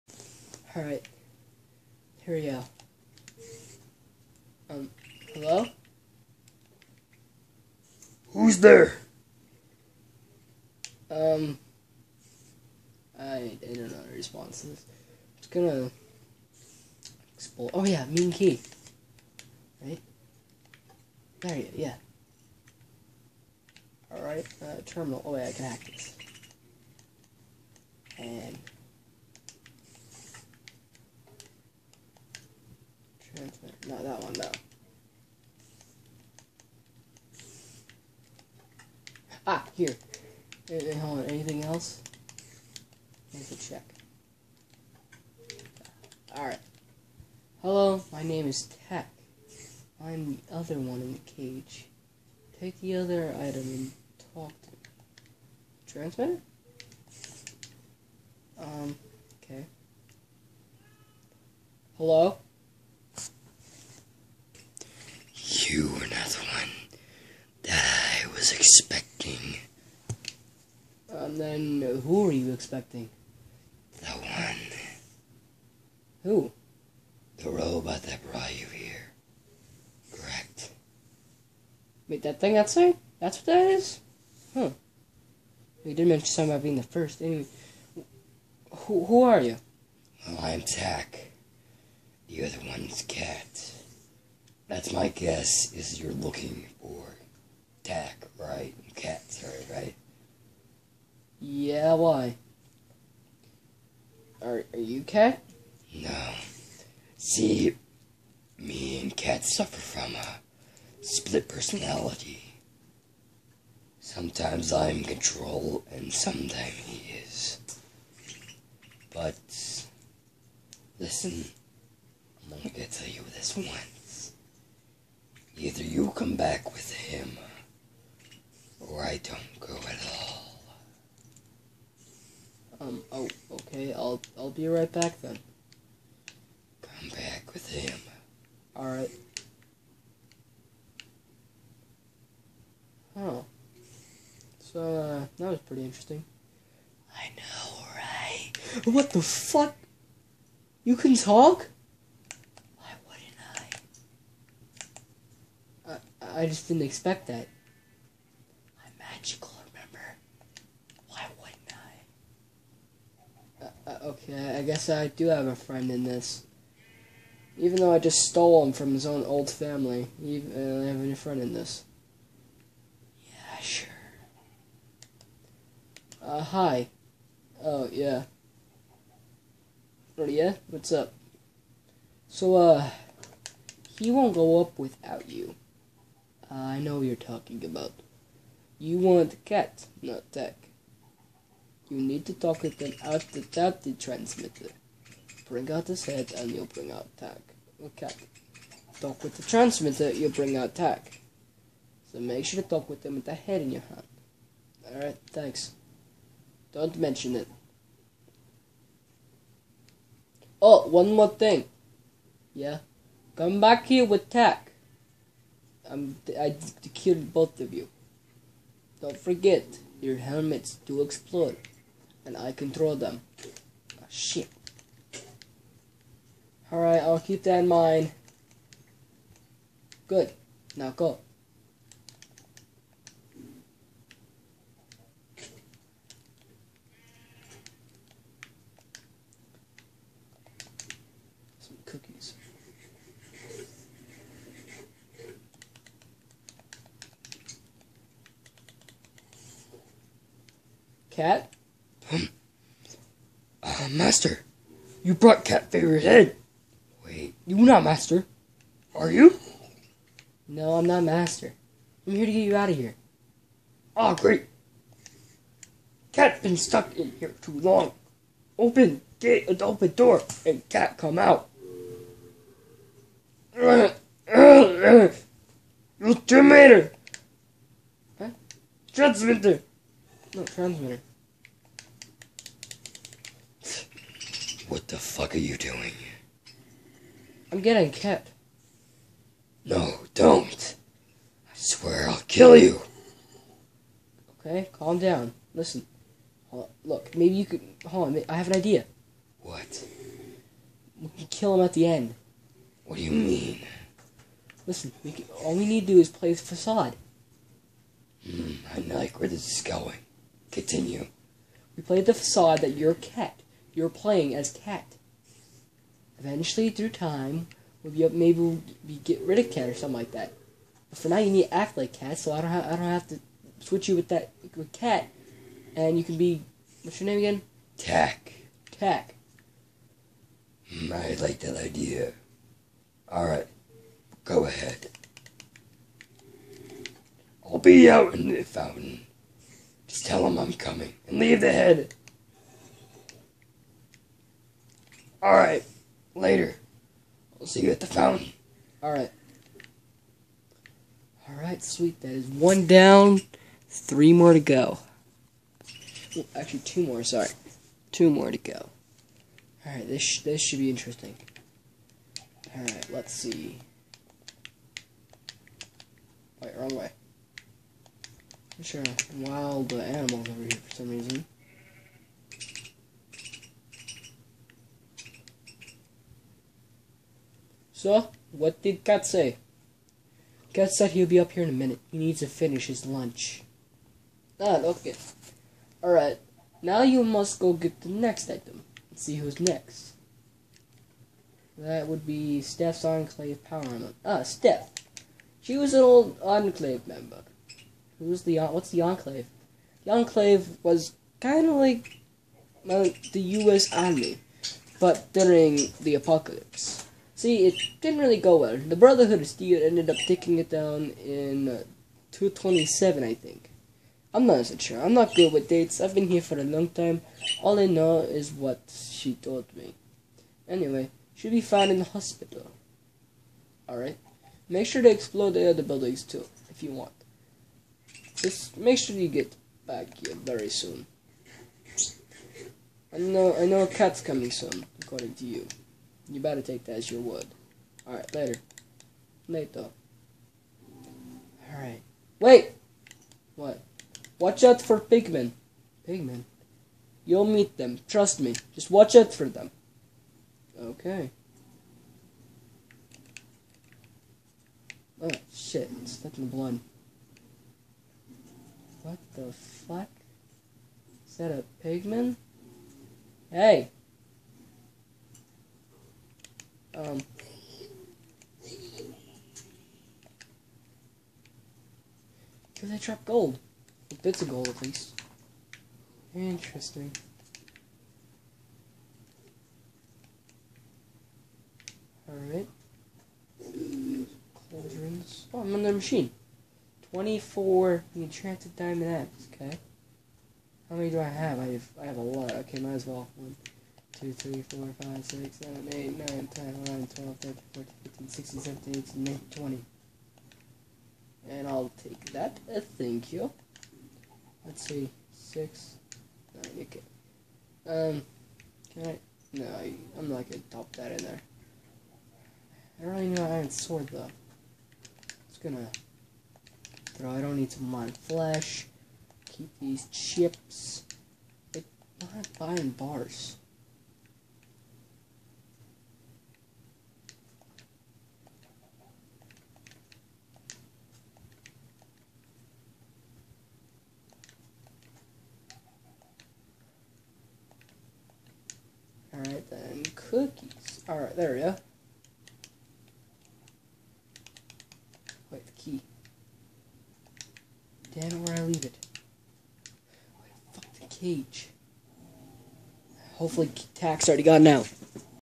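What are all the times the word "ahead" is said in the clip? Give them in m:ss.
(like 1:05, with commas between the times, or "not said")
5:34.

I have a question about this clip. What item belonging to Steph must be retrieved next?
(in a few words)
Enclave Power Armor.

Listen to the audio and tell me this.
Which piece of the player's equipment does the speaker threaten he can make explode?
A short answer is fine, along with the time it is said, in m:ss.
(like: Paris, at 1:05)
helmets, at 3:40.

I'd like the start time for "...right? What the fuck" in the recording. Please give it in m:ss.
2:27.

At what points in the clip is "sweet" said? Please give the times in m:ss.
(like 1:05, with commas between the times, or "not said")
5:51.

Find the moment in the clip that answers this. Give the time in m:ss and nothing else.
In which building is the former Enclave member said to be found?
7:01.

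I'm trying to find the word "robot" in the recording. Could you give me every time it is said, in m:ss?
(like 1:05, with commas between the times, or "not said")
1:17.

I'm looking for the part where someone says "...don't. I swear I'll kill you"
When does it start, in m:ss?
4:50.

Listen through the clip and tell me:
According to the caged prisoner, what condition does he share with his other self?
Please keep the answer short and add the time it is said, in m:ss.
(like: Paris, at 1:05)
split personality, at 1:51.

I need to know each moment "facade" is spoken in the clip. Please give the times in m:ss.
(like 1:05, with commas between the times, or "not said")
5:06, 5:12.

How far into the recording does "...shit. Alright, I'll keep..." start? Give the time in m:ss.
3:44.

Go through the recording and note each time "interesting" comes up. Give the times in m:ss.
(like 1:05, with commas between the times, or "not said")
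2:25, 6:00, 7:56.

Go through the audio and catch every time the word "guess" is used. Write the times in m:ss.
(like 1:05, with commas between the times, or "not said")
1:35, 2:44.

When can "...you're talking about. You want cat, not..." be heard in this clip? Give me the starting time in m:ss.
3:06.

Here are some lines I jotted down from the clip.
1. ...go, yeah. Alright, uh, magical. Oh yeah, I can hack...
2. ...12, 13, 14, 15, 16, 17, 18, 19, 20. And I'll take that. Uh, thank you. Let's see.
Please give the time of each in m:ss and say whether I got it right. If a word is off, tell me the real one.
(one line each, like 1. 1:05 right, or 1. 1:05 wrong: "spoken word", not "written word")
1. 0:21 wrong: "terminal", not "magical"
2. 8:16 right.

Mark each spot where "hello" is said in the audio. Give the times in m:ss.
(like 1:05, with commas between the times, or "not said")
0:05, 0:47, 1:01.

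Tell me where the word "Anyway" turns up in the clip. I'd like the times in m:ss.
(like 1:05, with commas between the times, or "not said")
1:27, 7:00.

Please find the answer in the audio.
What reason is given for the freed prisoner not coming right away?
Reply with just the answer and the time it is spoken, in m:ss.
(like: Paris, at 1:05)
finish his lunch, at 6:22.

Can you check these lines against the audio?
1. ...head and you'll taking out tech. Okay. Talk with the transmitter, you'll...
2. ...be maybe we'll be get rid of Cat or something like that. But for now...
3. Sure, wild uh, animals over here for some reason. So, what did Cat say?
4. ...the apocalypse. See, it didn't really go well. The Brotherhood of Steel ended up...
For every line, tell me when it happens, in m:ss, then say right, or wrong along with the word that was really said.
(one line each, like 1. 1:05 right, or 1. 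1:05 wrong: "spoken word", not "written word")
1. 3:16 wrong: "bring", not "taking"
2. 5:17 right
3. 6:08 right
4. 6:45 right.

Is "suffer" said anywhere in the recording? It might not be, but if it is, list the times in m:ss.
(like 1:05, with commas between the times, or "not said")
1:49.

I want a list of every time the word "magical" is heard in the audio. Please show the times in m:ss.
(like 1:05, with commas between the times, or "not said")
2:38.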